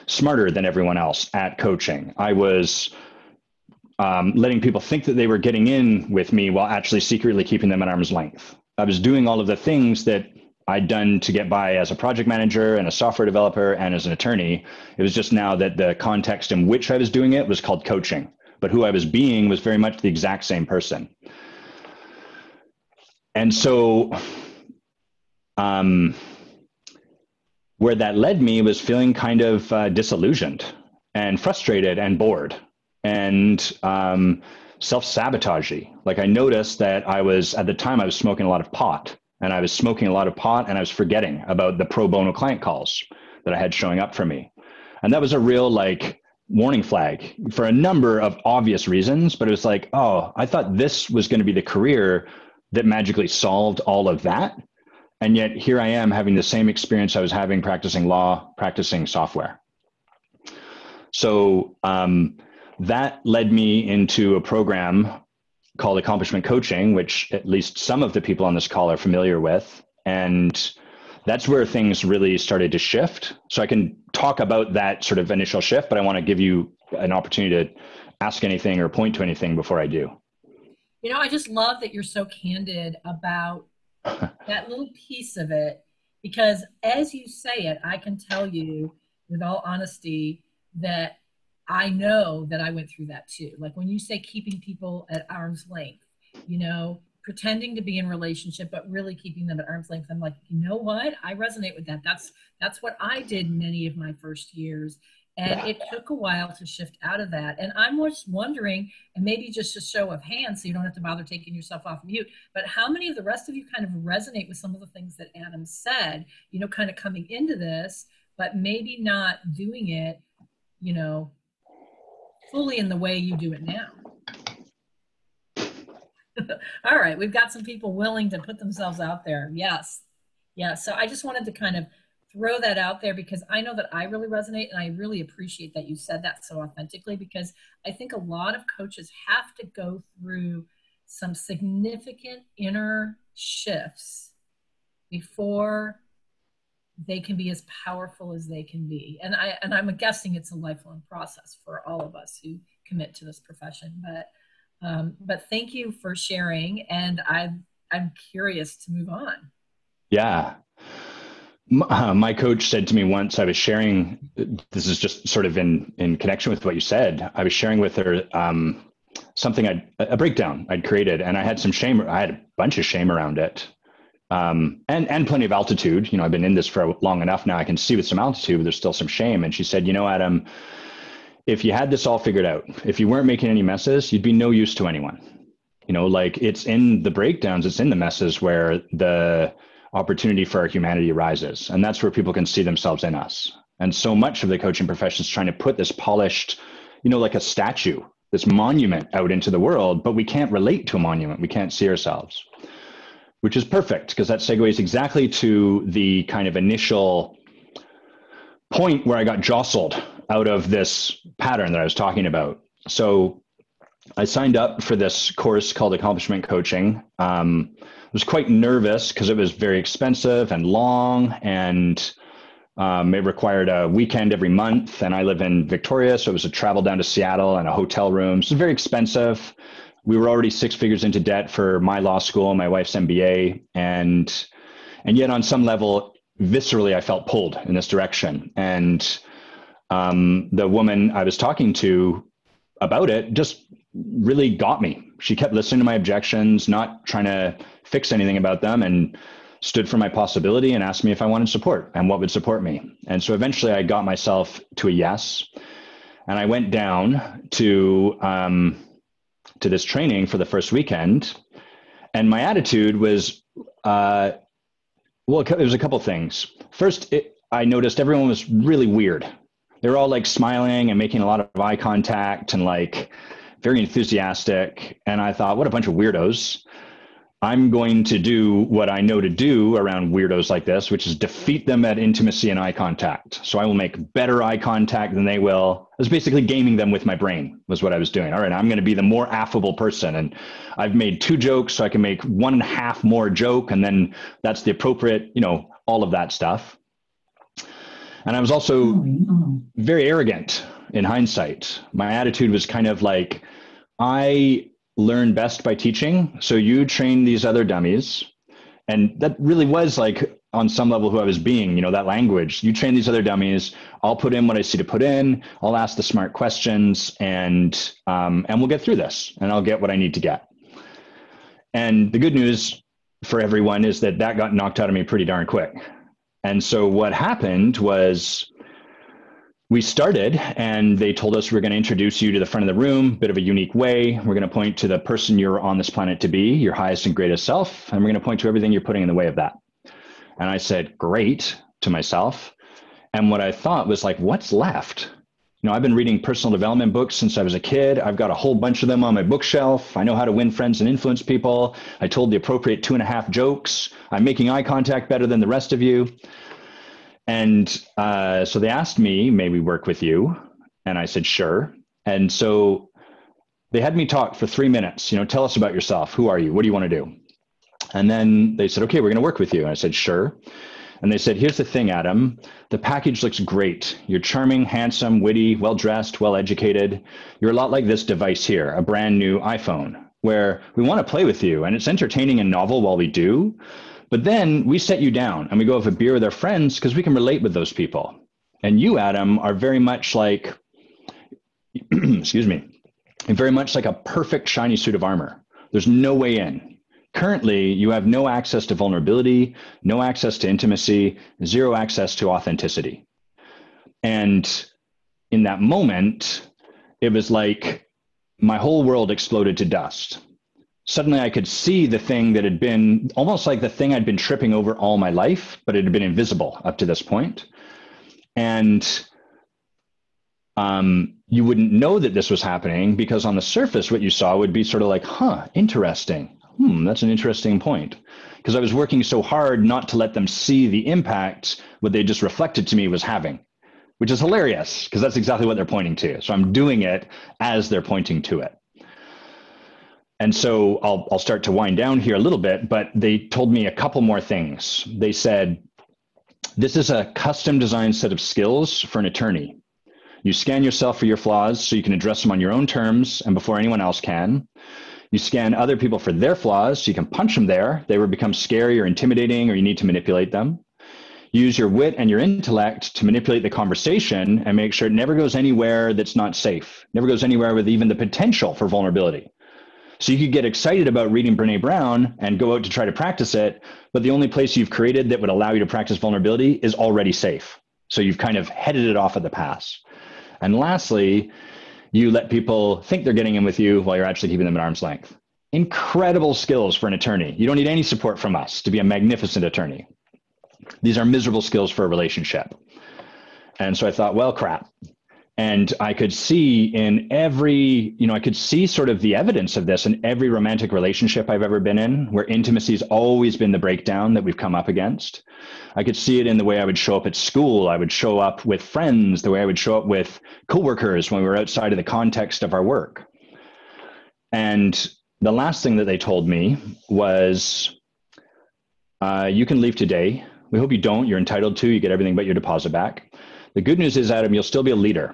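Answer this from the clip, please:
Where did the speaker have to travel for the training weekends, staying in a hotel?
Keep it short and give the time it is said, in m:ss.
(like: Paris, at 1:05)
Seattle, at 3:47.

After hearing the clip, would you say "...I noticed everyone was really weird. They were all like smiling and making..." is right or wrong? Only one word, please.
right.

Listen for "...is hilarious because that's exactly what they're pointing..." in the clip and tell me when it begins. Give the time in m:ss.
7:14.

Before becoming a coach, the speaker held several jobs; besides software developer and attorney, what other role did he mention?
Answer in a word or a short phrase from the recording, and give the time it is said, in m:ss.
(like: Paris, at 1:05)
project manager, at 0:11.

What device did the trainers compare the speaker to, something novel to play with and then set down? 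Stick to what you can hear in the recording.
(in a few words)
iPhone.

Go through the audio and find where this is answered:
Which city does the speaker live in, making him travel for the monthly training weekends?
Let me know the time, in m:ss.
3:45.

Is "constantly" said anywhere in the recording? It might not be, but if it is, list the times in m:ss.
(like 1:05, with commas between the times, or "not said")
not said.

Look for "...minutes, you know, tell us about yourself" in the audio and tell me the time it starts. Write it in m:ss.
6:04.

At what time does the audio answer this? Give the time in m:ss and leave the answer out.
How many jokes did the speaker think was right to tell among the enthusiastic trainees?
5:52.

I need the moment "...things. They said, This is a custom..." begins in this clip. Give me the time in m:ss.
7:24.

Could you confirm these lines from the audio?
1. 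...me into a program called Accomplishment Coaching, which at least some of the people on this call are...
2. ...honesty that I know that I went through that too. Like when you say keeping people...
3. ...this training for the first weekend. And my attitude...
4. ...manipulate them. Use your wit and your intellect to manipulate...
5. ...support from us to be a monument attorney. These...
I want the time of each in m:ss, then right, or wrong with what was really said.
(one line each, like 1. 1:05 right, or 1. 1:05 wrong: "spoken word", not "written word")
1. 1:03 right
2. 1:29 right
3. 4:19 right
4. 7:39 right
5. 8:07 wrong: "magnificent", not "monument".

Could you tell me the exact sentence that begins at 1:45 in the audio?
it took a while to shift out of that.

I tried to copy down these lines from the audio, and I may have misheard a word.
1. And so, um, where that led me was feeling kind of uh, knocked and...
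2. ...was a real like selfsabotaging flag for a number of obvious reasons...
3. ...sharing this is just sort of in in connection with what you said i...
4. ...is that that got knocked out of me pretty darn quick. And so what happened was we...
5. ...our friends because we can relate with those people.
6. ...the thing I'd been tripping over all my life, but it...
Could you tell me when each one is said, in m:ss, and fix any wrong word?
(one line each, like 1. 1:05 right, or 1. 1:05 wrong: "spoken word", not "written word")
1. 0:23 wrong: "disillusioned", not "knocked"
2. 0:45 wrong: "warning", not "selfsabotaging"
3. 2:43 right
4. 5:23 right
5. 6:26 right
6. 6:53 right.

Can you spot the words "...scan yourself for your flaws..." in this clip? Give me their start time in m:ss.
7:30.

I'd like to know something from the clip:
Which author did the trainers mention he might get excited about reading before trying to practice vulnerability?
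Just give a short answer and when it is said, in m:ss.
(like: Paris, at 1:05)
Brene Brown, at 7:51.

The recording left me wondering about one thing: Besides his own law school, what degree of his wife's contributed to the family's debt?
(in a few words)
MBA.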